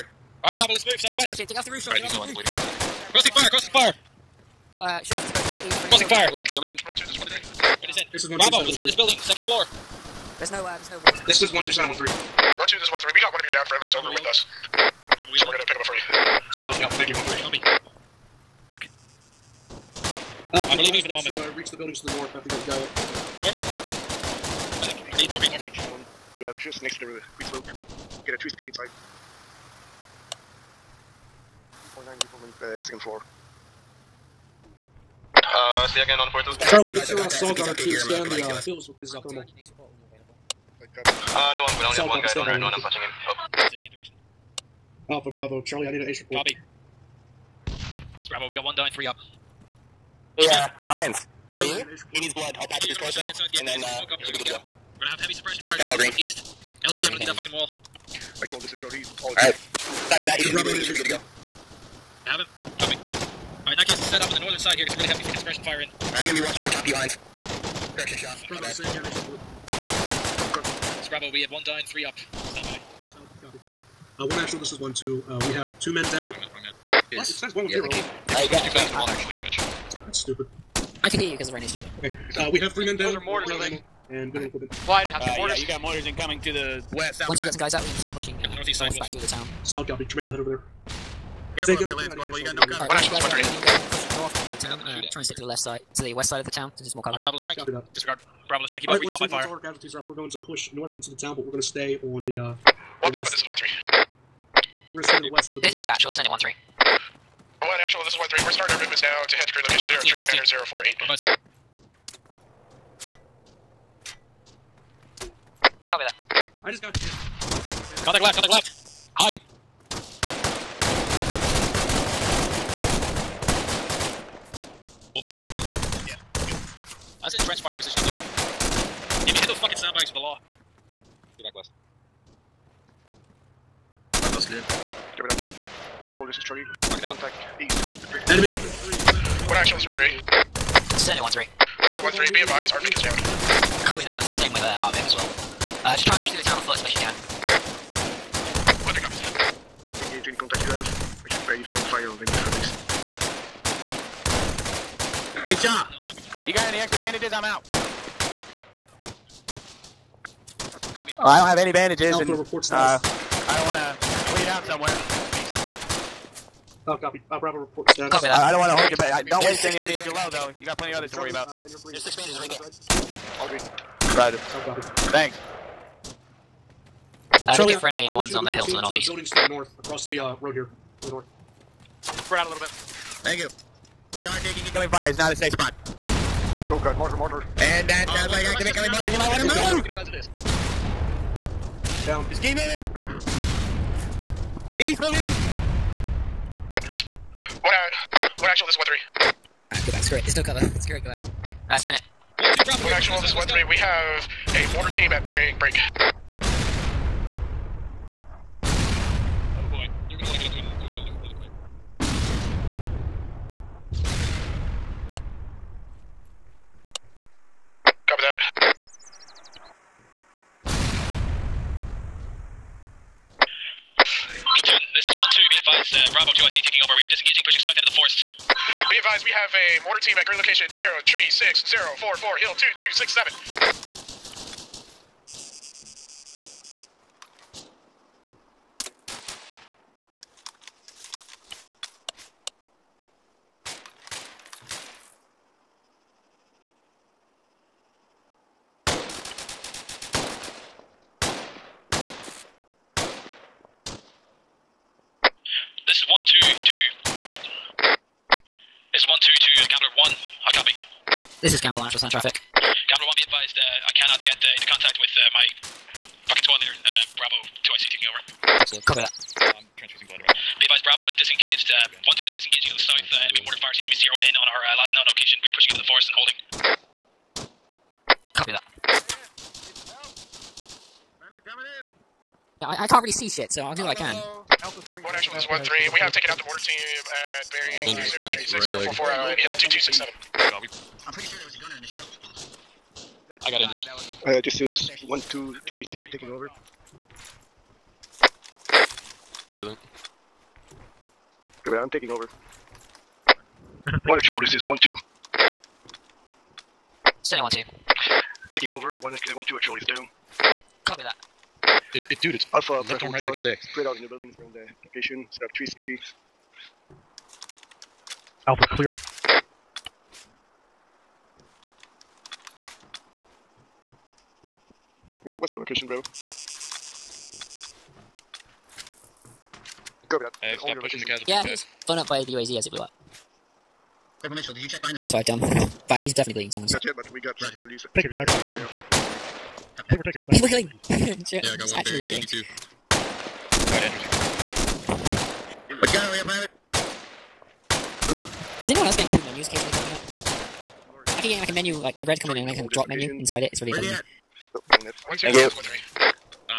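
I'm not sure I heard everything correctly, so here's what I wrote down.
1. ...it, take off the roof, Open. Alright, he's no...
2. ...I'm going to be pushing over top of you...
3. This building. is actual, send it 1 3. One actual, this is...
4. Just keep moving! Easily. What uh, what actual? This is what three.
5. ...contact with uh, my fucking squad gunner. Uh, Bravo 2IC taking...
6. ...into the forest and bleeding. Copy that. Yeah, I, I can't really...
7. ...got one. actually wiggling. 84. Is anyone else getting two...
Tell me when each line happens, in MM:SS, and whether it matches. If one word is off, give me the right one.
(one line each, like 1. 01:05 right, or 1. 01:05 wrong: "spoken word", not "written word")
1. 00:01 wrong: "Sean", not "Open"
2. 01:06 wrong: "watching", not "pushing"
3. 01:45 right
4. 03:12 right
5. 04:24 wrong: "leader", not "gunner"
6. 04:35 wrong: "holding", not "bleeding"
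7. 05:41 wrong: "82", not "84".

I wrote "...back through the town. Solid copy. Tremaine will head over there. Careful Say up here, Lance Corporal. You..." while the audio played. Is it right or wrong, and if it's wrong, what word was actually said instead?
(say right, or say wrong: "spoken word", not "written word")
right.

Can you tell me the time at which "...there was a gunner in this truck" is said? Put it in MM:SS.
04:51.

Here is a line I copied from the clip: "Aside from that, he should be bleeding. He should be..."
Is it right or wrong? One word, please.
right.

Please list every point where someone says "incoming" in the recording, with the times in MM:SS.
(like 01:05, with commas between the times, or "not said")
01:26, 03:04, 03:08.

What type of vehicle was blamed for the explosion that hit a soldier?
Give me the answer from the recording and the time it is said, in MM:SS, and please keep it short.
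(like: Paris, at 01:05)
UAZ, at 05:32.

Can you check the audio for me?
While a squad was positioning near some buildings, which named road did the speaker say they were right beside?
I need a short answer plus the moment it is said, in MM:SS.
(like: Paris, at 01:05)
Queen's Road, at 00:27.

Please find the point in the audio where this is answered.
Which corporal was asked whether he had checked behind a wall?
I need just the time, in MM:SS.
05:34.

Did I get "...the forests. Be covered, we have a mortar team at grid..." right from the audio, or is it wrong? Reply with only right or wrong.
wrong.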